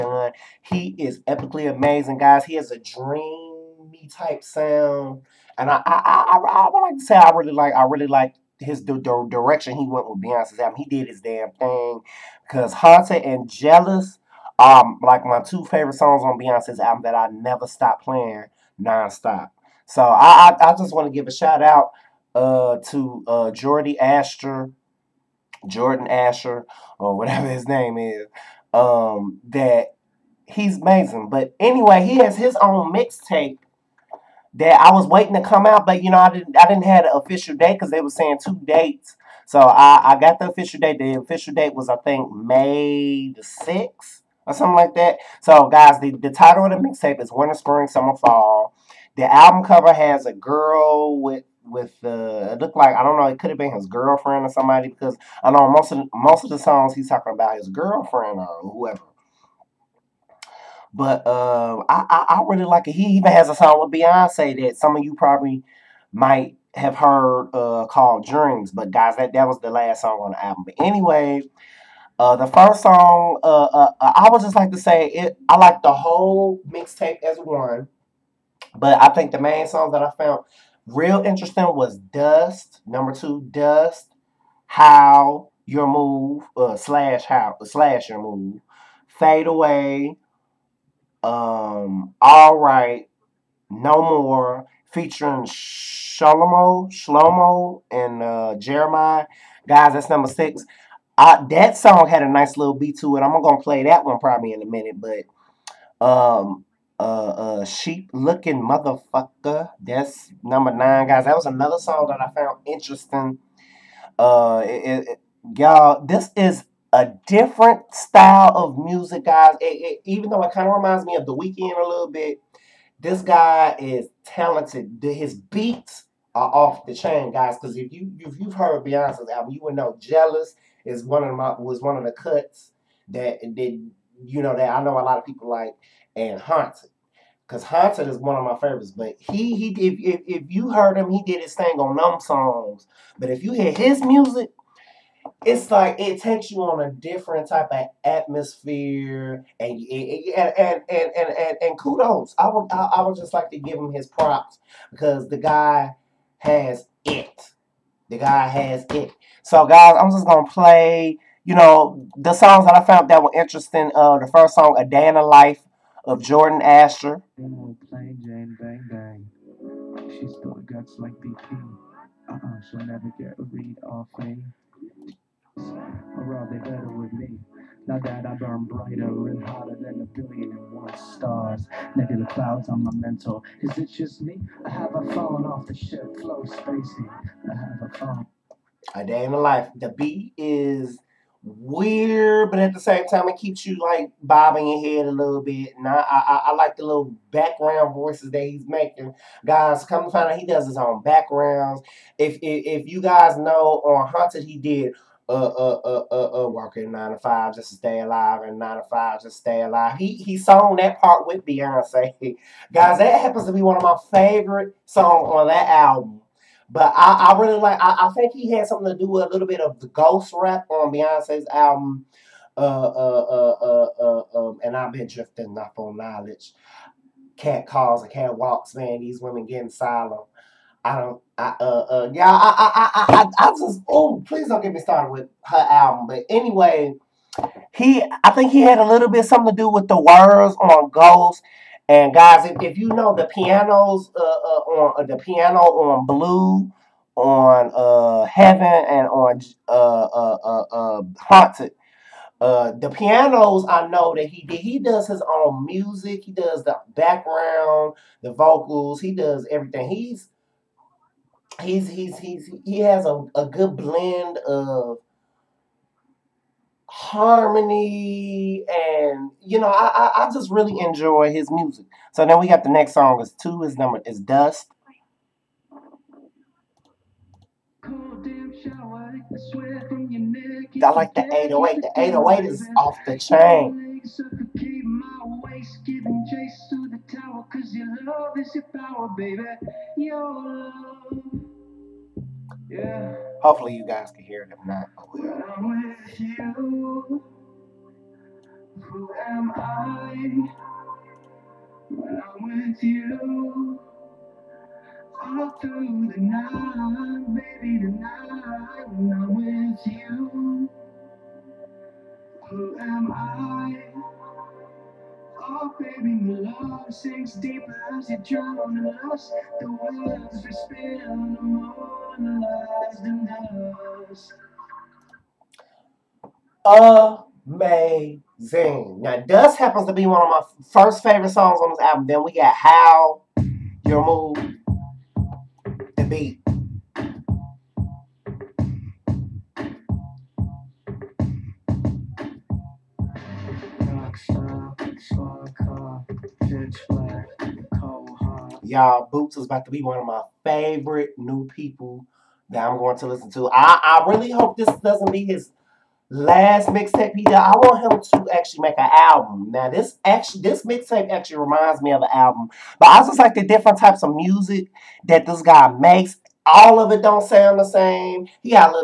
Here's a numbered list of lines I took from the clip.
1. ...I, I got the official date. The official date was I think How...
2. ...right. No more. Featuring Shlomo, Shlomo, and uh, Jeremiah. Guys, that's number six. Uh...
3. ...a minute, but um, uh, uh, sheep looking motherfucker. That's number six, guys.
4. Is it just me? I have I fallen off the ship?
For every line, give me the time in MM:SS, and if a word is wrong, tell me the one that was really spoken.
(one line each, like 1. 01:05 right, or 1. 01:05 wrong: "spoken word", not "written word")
1. 00:39 wrong: "May", not "How"
2. 01:32 right
3. 01:44 wrong: "nine", not "six"
4. 03:03 right.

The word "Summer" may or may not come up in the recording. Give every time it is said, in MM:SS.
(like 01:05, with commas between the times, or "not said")
00:47.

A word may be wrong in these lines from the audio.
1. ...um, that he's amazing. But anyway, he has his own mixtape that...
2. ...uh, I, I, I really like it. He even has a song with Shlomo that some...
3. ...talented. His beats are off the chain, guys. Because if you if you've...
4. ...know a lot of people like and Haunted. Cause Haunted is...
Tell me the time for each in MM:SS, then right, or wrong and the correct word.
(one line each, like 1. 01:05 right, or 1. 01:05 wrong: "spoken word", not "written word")
1. 00:28 right
2. 01:01 wrong: "Beyonce", not "Shlomo"
3. 02:04 right
4. 02:14 right.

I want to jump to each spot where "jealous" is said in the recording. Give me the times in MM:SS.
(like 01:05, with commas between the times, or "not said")
00:13, 02:09.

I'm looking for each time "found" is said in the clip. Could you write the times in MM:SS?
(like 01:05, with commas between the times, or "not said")
01:20, 01:52, 02:42.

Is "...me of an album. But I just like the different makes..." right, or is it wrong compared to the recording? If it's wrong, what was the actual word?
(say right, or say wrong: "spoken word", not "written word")
wrong: "types", not "makes".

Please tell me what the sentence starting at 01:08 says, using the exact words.
But guys, that that was the last song on the album.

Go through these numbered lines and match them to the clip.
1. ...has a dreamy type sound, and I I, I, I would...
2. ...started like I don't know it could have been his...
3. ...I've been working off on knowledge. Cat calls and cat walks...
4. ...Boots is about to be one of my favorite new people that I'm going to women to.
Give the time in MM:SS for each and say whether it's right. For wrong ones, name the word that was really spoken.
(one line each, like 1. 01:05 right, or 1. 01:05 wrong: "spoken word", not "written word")
1. 00:02 right
2. 00:52 wrong: "looked", not "started"
3. 03:44 wrong: "drifting", not "working"
4. 05:49 wrong: "listen", not "women".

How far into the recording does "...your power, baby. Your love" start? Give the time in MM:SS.
04:48.